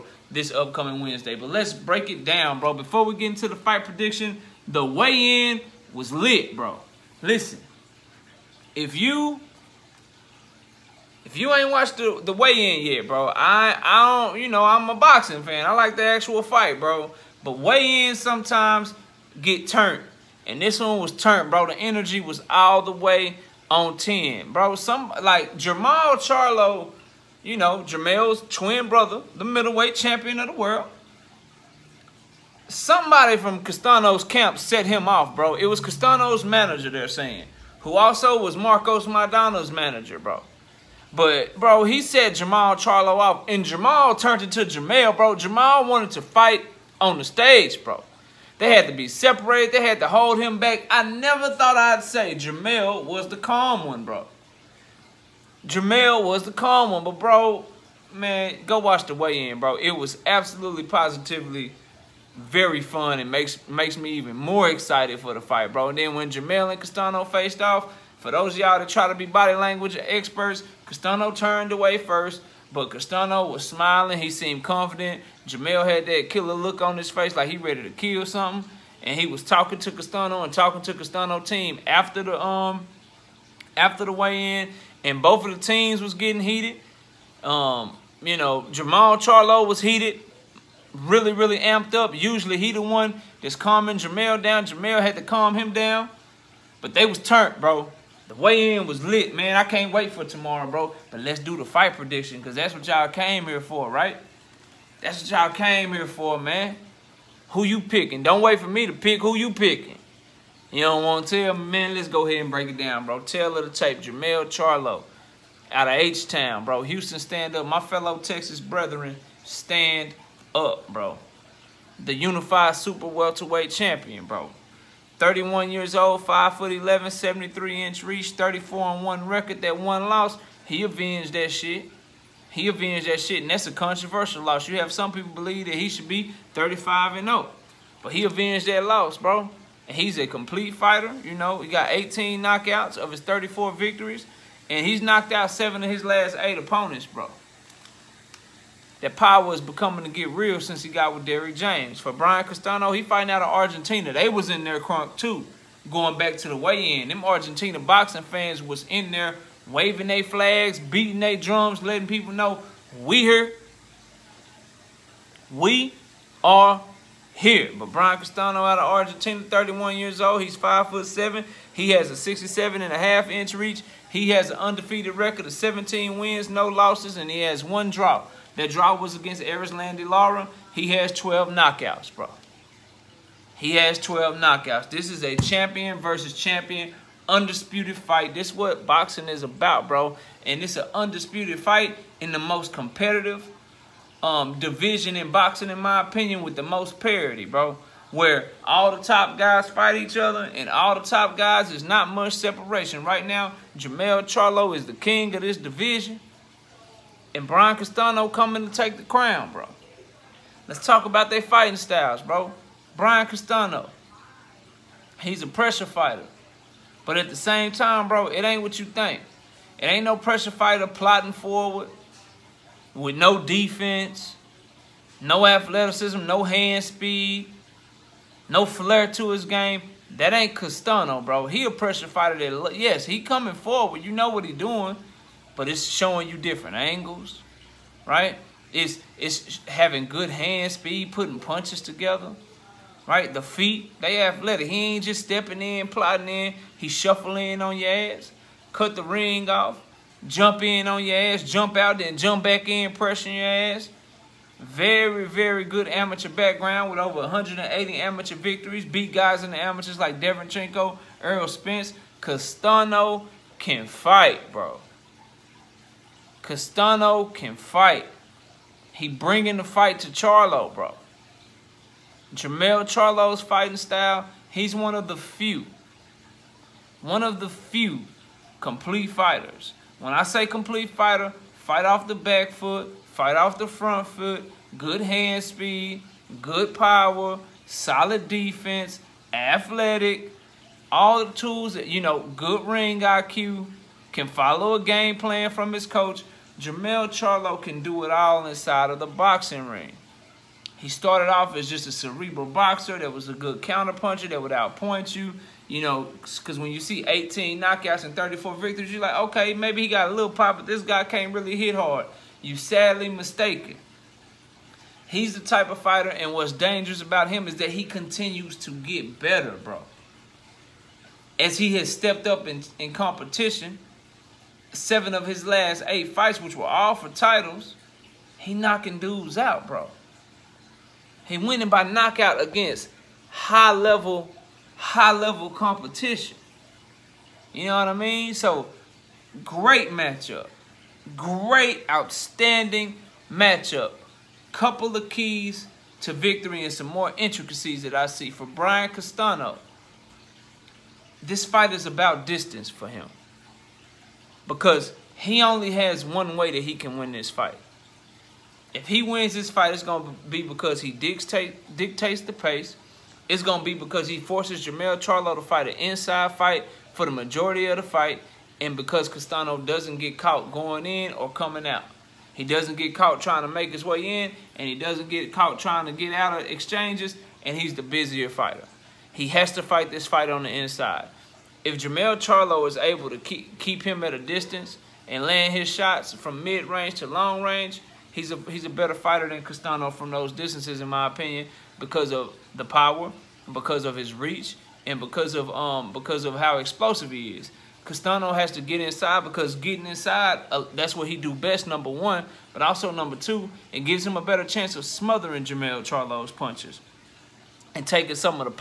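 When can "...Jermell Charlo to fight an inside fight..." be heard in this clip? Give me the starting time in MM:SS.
06:04.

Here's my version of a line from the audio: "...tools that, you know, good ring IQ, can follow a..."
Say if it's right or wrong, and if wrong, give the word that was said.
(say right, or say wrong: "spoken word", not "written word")
right.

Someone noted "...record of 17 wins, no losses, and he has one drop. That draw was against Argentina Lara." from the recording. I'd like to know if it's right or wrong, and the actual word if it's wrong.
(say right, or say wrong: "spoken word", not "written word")
wrong: "Eris", not "Argentina".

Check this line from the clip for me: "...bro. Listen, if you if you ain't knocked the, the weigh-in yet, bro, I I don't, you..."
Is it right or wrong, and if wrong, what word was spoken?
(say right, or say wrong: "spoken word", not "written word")
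wrong: "watched", not "knocked".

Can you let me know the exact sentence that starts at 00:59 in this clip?
It was absolutely positively very fun It makes makes me even more excited for the fight, bro.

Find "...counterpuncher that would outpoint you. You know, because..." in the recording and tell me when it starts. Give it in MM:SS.
05:03.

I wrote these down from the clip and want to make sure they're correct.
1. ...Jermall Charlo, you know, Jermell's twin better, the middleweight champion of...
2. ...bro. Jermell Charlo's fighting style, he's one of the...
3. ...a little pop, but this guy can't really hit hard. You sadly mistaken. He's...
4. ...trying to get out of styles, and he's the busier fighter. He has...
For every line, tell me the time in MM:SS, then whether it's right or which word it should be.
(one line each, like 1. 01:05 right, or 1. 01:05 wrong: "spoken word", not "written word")
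1. 00:25 wrong: "brother", not "better"
2. 04:30 right
3. 05:10 right
4. 06:15 wrong: "exchanges", not "styles".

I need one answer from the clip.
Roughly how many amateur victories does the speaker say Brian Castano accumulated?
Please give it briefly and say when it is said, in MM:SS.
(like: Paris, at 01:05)
over 180, at 04:17.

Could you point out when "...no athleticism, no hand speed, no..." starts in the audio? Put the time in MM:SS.
03:45.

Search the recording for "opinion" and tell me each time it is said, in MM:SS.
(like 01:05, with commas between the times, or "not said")
03:16, 06:31.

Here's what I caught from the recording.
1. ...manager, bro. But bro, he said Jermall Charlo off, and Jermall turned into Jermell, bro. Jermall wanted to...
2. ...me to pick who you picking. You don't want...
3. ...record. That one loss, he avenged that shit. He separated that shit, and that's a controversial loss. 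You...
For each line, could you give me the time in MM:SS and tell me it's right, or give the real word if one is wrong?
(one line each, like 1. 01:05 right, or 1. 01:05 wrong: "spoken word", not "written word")
1. 00:39 right
2. 01:48 right
3. 02:09 wrong: "avenged", not "separated".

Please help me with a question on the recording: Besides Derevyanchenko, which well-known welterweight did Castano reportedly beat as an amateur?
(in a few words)
Errol Spence.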